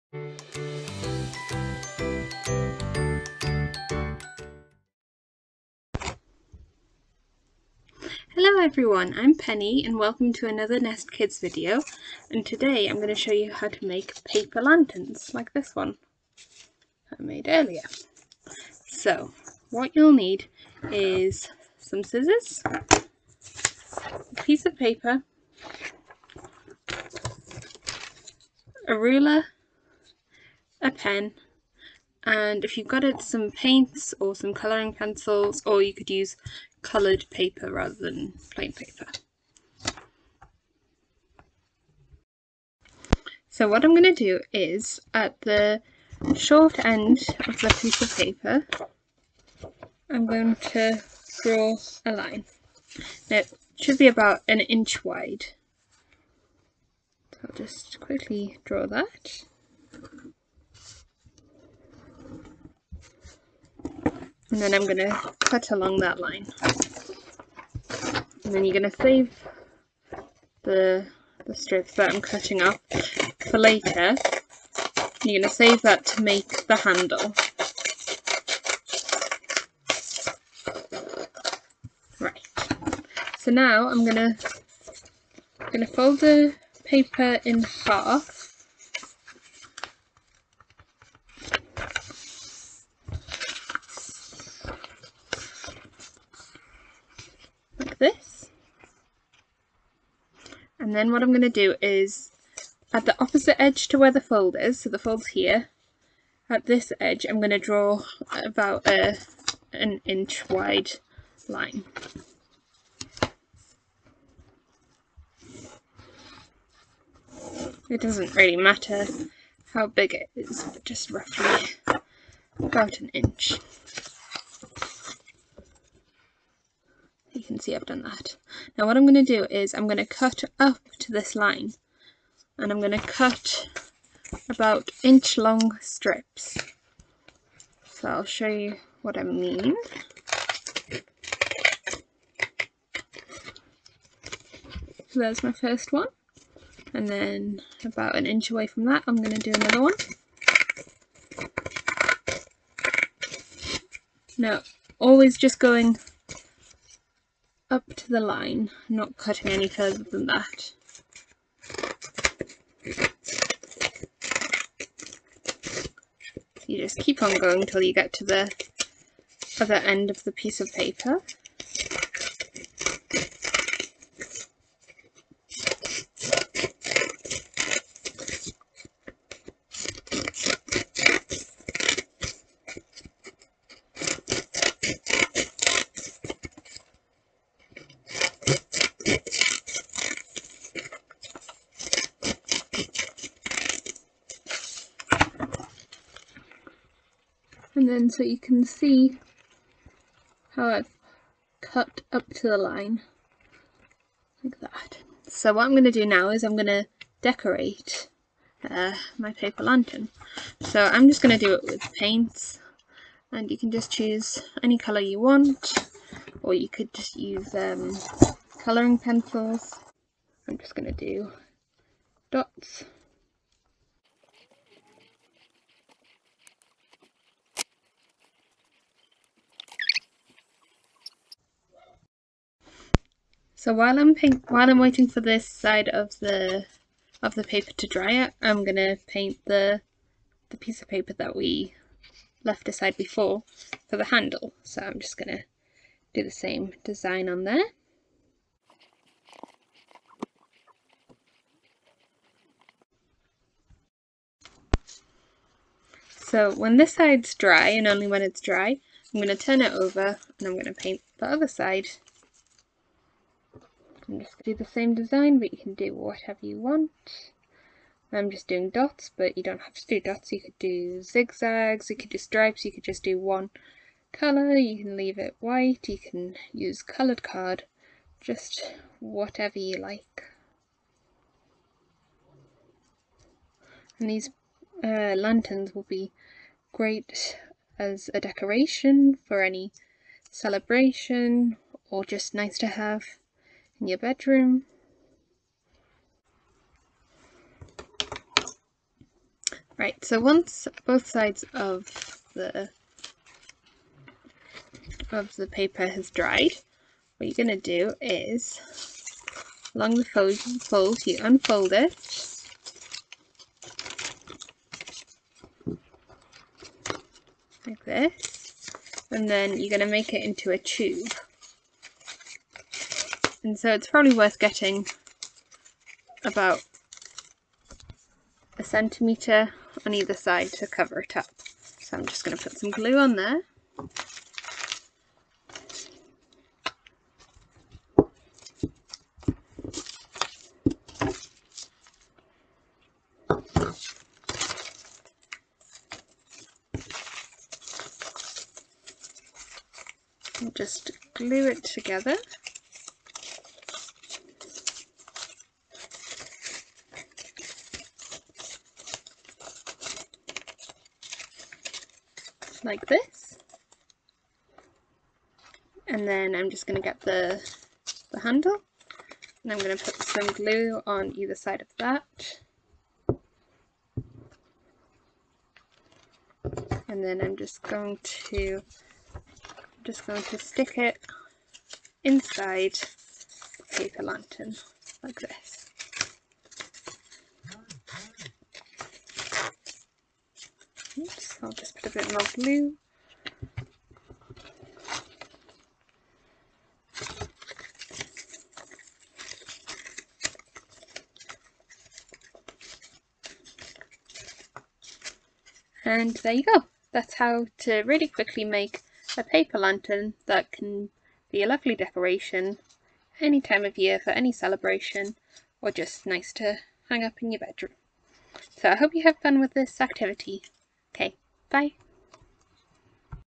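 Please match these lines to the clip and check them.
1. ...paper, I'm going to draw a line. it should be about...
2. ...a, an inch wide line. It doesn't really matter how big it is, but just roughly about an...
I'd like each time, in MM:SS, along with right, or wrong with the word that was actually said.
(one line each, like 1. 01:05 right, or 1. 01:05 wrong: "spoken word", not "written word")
1. 00:48 right
2. 01:48 right.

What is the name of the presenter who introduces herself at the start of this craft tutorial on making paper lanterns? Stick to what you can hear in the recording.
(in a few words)
Penny.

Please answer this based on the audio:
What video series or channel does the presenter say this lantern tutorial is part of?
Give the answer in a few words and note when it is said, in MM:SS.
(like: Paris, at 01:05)
Nest Kids, at 00:10.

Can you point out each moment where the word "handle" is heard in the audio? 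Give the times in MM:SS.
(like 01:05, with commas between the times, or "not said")
01:16, 04:04, 06:08.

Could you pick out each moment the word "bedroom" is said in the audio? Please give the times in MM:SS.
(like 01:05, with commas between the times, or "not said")
04:53, 06:57.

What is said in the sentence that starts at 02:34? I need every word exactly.
Now always just going up to the line, not cutting any further than that.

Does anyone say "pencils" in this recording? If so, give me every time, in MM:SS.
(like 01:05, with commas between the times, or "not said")
00:34, 03:38.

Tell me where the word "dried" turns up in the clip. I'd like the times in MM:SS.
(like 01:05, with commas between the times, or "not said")
05:06.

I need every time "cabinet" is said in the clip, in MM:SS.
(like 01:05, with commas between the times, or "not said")
not said.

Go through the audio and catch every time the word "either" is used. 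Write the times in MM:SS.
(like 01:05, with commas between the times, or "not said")
05:29, 06:11.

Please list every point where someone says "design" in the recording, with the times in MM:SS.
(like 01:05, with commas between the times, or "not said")
04:06, 04:24.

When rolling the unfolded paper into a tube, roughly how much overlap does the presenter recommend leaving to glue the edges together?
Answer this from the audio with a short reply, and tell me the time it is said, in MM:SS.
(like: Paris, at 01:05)
1 centimetre, at 05:28.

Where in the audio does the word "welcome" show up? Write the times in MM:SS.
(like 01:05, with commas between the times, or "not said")
00:09.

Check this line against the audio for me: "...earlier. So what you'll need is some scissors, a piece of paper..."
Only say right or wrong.
right.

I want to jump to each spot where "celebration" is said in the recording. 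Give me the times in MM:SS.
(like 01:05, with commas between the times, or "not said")
04:50, 06:54.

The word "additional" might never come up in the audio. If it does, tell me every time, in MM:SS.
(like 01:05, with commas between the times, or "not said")
not said.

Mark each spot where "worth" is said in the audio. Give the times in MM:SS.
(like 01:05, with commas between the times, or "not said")
05:24.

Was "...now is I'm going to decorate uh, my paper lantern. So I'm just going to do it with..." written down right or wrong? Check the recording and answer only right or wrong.
right.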